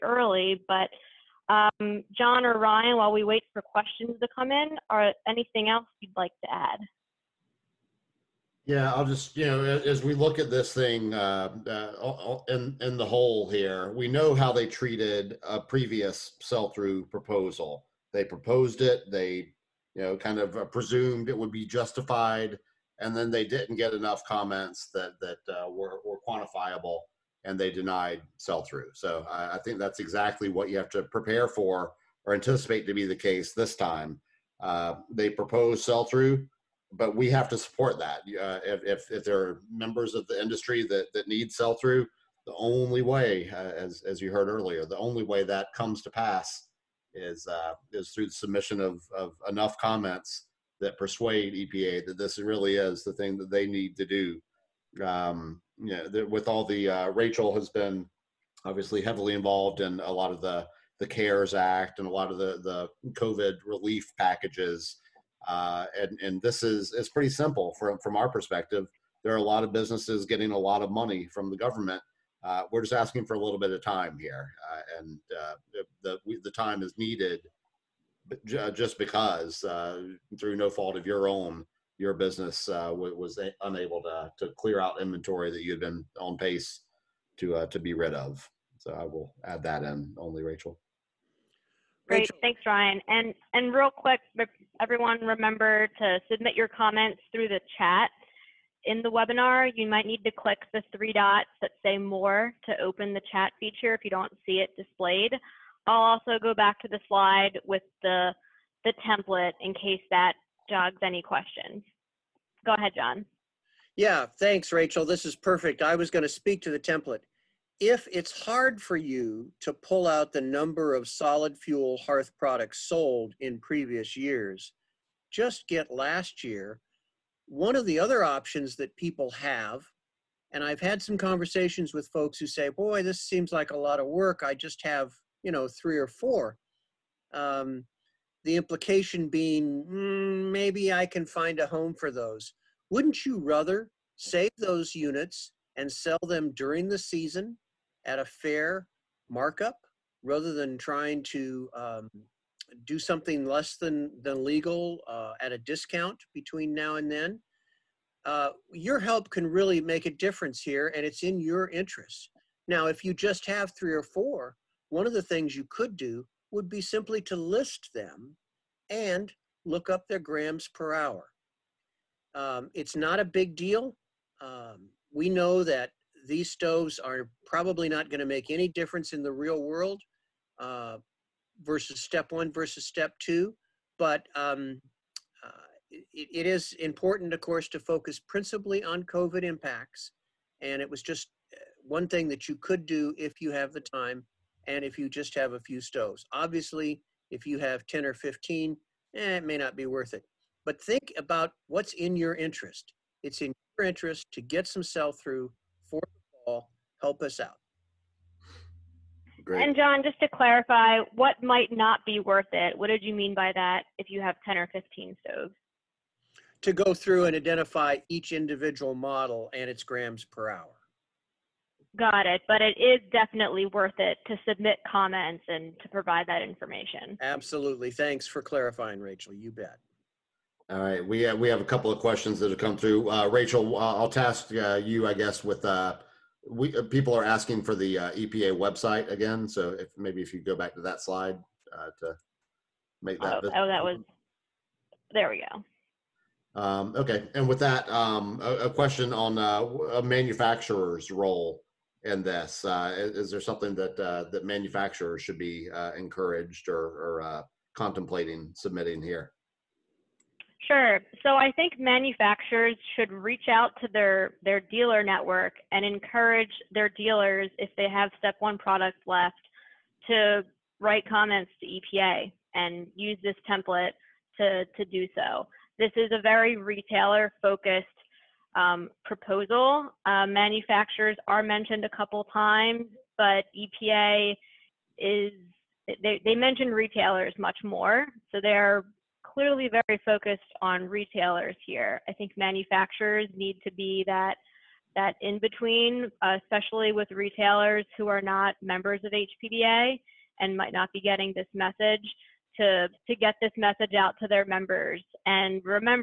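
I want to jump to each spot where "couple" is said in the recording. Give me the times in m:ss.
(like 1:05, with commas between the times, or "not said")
3:51, 4:41.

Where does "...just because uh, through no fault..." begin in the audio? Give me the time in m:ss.
1:18.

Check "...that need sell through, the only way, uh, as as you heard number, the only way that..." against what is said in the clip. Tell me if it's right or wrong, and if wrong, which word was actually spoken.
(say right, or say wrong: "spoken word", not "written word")
wrong: "earlier", not "number".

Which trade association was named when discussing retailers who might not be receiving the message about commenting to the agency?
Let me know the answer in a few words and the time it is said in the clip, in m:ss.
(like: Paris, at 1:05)
HPBA, at 4:59.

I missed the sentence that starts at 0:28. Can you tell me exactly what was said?
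So I, I, think that's exactly what you have to prepare for or anticipate to be the case this time.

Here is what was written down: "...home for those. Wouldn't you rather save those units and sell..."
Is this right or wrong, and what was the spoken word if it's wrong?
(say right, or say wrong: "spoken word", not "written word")
right.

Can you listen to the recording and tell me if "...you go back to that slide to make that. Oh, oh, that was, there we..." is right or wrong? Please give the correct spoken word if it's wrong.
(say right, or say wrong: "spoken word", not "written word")
right.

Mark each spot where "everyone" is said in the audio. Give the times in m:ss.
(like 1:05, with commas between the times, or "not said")
1:34.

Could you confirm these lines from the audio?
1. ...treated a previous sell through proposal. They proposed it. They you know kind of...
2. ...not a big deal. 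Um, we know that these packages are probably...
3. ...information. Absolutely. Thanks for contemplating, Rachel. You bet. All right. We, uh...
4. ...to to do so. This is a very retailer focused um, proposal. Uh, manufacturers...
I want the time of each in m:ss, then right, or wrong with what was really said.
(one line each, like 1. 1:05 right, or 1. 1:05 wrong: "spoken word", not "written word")
1. 0:14 right
2. 2:52 wrong: "stoves", not "packages"
3. 3:46 wrong: "clarifying", not "contemplating"
4. 4:34 right.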